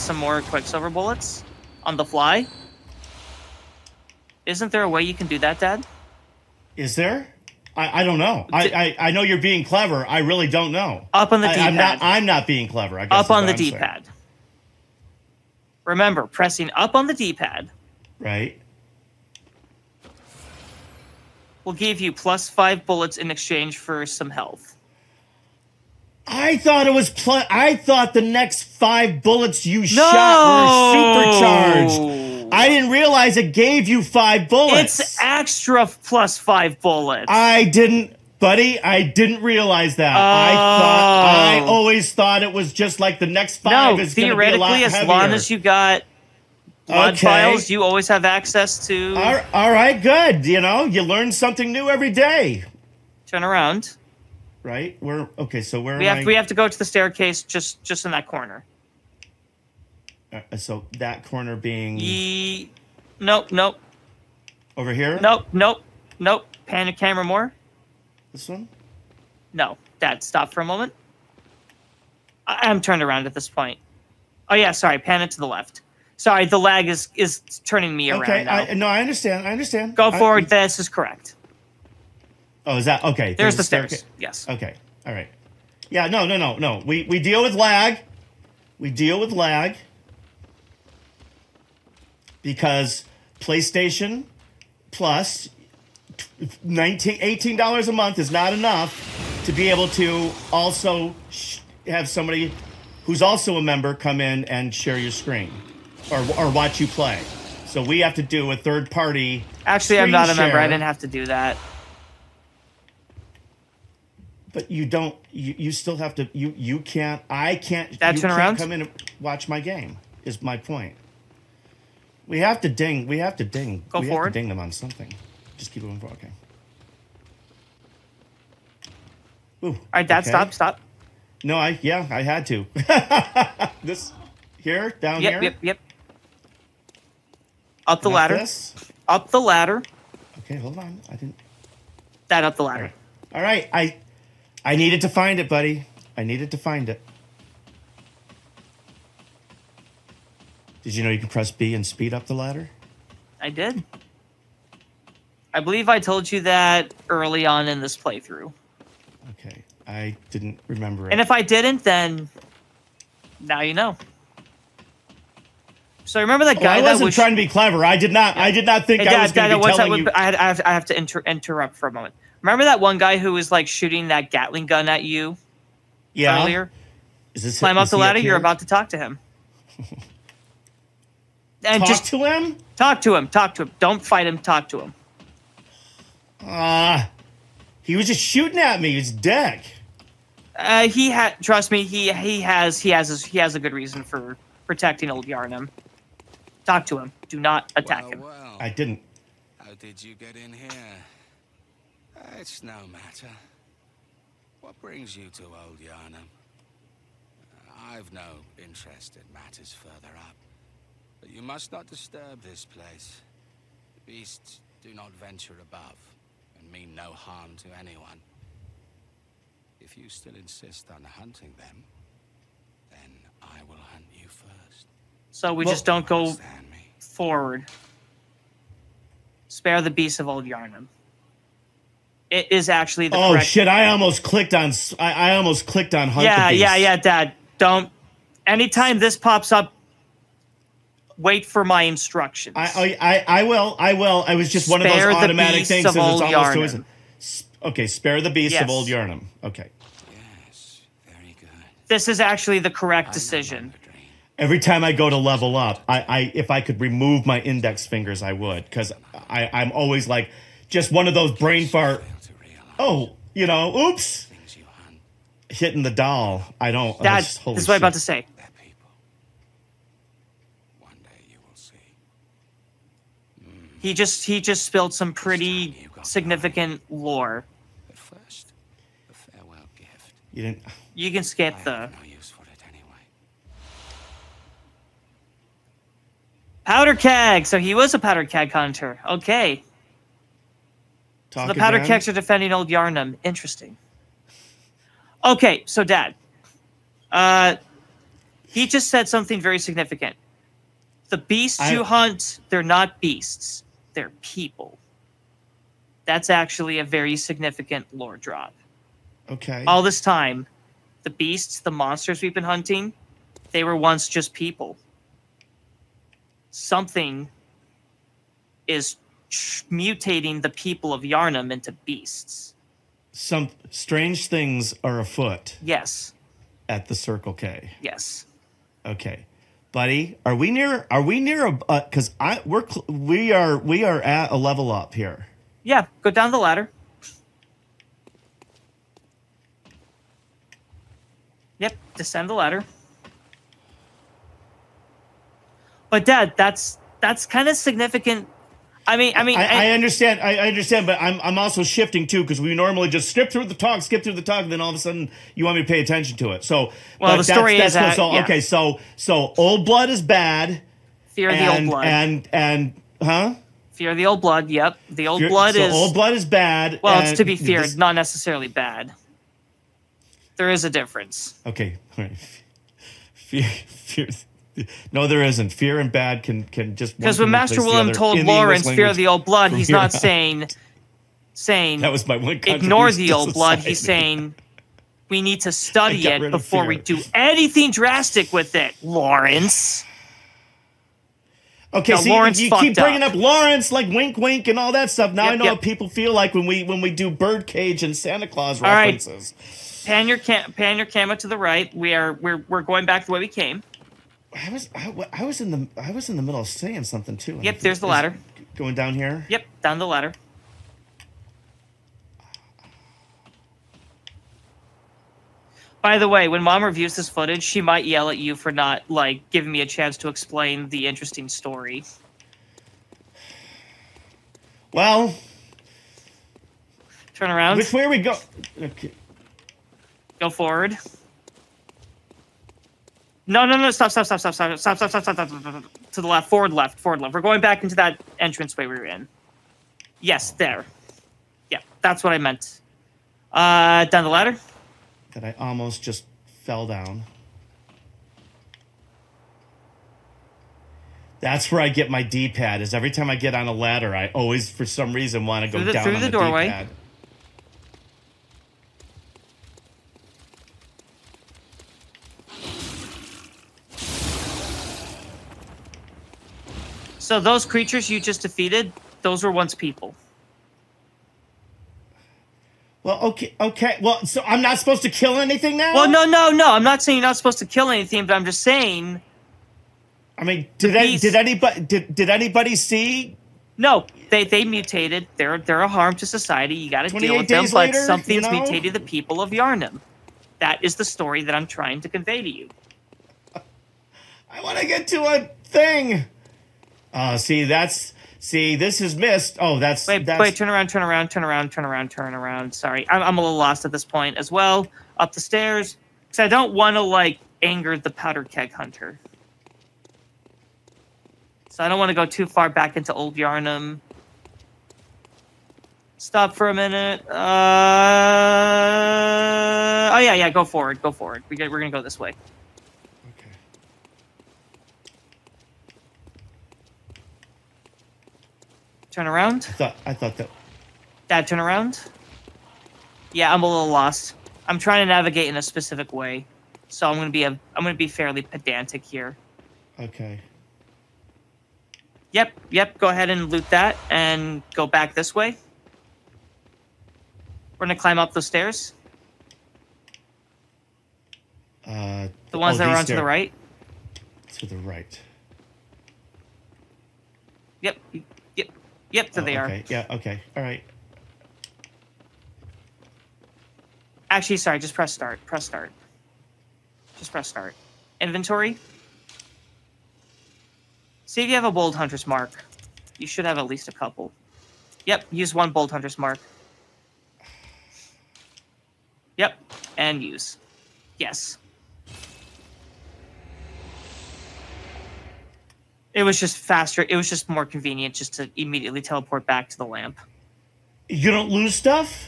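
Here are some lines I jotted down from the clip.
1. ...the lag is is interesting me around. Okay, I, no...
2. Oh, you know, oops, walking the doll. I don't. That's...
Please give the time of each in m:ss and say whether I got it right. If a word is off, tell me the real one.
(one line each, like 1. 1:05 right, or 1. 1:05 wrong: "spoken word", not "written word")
1. 1:16 wrong: "turning", not "interesting"
2. 4:22 wrong: "hitting", not "walking".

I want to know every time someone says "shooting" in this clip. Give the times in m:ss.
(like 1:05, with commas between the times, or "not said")
2:53, 3:08.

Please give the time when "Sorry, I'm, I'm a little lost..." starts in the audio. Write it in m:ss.
8:22.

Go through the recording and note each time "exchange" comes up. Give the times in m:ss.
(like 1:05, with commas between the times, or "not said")
0:23.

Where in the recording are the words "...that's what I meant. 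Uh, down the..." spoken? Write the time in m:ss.
7:21.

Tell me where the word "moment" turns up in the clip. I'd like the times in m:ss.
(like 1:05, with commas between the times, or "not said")
1:10, 2:51.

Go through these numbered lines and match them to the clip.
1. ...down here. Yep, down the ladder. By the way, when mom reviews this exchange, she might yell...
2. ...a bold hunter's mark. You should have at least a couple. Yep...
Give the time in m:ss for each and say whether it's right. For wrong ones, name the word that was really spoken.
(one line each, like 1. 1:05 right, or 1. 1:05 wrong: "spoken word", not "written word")
1. 6:48 wrong: "footage", not "exchange"
2. 9:31 right.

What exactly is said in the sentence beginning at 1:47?
So we have to do a third party.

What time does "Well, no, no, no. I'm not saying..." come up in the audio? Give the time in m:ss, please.
7:55.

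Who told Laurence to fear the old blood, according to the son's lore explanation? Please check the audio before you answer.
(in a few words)
Master William.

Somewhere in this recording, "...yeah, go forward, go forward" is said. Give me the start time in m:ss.
8:40.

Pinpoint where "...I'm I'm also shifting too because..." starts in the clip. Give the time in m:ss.
5:51.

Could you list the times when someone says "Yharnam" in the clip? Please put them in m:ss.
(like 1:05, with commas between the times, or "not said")
3:15, 3:25, 3:50, 4:08, 4:52, 5:21, 8:09, 8:33.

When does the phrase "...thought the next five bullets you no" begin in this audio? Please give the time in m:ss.
0:27.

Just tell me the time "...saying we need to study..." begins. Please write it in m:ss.
6:23.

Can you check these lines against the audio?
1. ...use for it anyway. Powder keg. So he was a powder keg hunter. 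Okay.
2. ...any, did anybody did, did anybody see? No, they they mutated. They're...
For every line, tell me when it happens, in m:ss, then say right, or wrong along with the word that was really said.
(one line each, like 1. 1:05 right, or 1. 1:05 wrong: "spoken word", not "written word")
1. 4:42 right
2. 8:00 right.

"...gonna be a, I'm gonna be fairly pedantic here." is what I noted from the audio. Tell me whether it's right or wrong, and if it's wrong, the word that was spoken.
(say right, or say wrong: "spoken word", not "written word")
right.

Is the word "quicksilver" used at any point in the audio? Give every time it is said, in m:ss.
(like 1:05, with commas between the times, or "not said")
0:00.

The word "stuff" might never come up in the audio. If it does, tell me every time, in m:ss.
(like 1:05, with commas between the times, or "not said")
6:34, 9:51.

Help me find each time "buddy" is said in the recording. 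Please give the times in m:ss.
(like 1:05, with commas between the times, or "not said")
0:38, 2:25, 5:29.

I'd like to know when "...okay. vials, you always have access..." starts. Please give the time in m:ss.
0:47.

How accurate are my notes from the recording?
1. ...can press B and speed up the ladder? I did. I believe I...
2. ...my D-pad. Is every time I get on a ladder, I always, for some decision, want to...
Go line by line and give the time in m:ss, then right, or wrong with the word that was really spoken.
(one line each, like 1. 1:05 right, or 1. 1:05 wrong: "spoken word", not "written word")
1. 2:31 right
2. 7:31 wrong: "reason", not "decision".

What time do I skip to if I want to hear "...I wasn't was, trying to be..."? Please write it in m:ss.
2:46.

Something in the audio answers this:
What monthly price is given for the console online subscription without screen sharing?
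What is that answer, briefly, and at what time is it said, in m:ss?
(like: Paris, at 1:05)
$18, at 1:37.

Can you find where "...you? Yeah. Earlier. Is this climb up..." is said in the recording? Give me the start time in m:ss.
2:55.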